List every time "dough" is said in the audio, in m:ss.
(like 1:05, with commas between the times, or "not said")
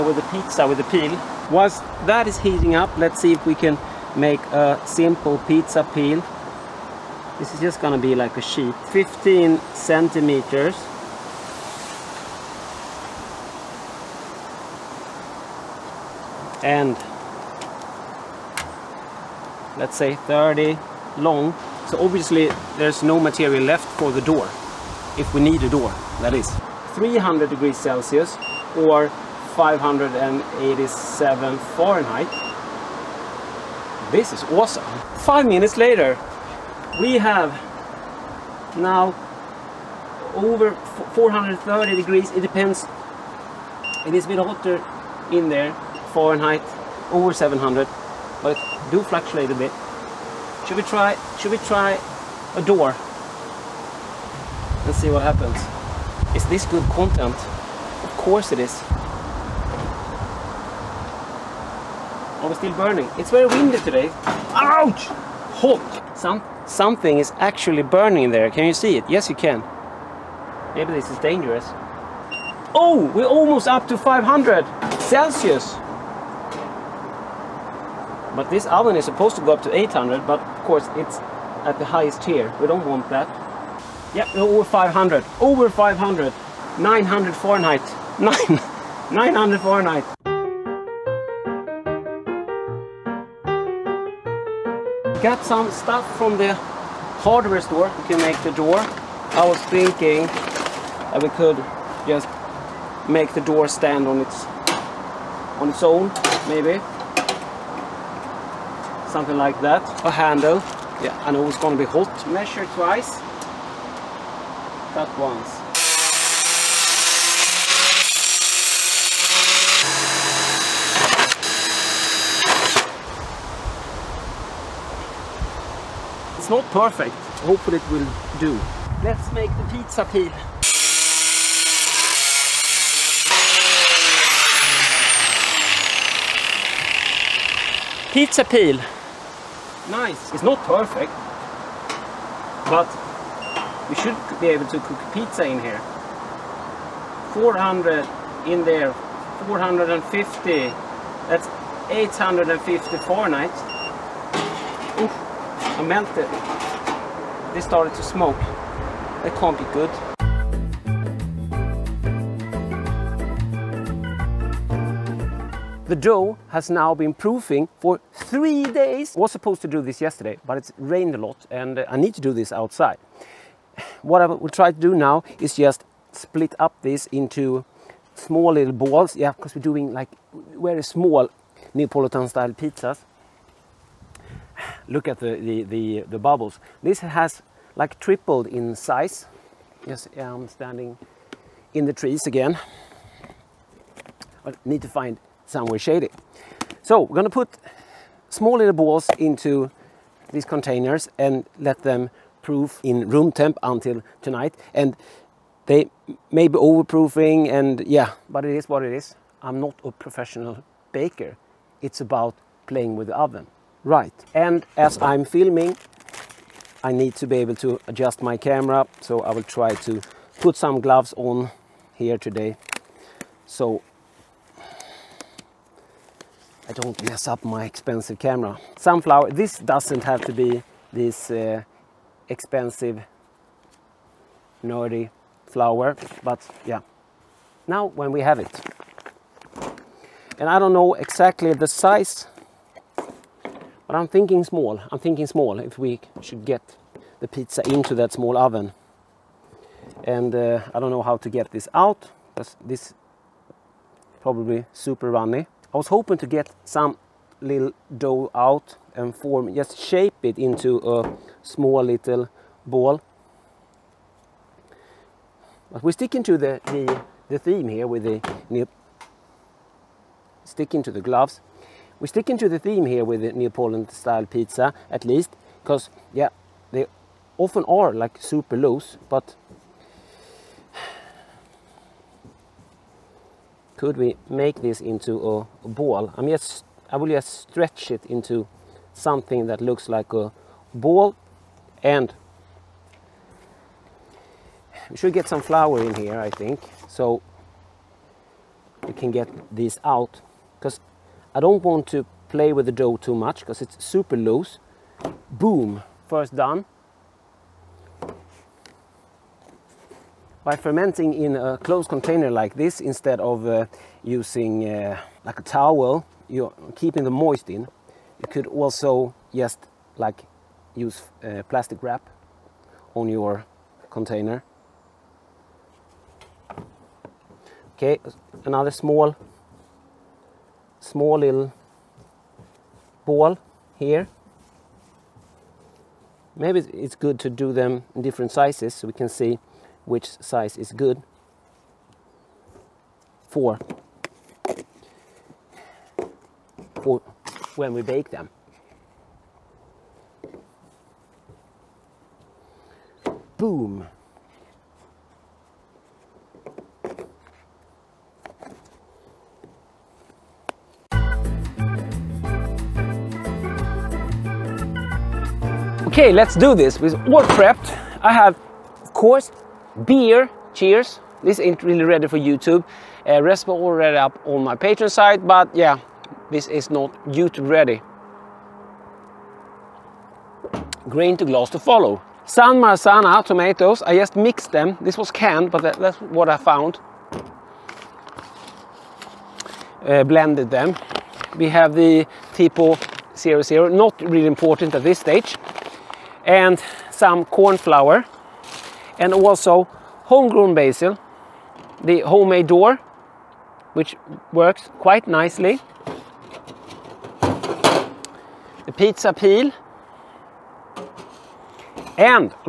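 2:45, 4:17, 5:02.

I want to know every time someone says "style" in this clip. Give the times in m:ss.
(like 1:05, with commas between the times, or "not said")
3:02, 4:33.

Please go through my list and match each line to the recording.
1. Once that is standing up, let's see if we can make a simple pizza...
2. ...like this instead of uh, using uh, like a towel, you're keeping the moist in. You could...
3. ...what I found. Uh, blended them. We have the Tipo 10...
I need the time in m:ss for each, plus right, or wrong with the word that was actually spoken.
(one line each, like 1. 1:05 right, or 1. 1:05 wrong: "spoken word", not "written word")
1. 0:01 wrong: "heating", not "standing"
2. 5:12 right
3. 6:26 wrong: "00", not "10".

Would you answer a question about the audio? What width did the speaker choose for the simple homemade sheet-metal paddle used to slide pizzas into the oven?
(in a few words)
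15 centimeters.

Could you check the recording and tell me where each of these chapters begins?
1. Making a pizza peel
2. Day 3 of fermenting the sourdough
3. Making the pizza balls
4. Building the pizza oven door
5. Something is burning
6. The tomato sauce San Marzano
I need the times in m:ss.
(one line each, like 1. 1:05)
1. 2:06
2. 2:40
3. 3:49
4. 1:30
5. 1:05
6. 6:21.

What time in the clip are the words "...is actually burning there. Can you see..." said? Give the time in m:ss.
1:07.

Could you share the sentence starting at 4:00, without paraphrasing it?
And I don't know exactly the size, but I'm thinking small.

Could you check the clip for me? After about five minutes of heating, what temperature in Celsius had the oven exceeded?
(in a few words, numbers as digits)
430 degrees.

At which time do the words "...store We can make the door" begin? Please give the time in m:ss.
1:37.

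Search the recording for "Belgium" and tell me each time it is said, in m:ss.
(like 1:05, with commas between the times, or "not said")
not said.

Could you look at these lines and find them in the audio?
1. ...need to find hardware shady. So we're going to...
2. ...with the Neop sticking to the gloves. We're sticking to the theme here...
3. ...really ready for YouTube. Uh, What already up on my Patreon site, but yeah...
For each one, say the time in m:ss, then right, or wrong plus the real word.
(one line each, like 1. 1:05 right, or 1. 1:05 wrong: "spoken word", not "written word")
1. 3:14 wrong: "somewhere", not "hardware"
2. 4:27 right
3. 6:11 wrong: "Respa", not "What".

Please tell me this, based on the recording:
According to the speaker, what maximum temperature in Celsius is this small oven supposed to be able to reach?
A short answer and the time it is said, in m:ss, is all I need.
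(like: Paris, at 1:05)
800, at 1:19.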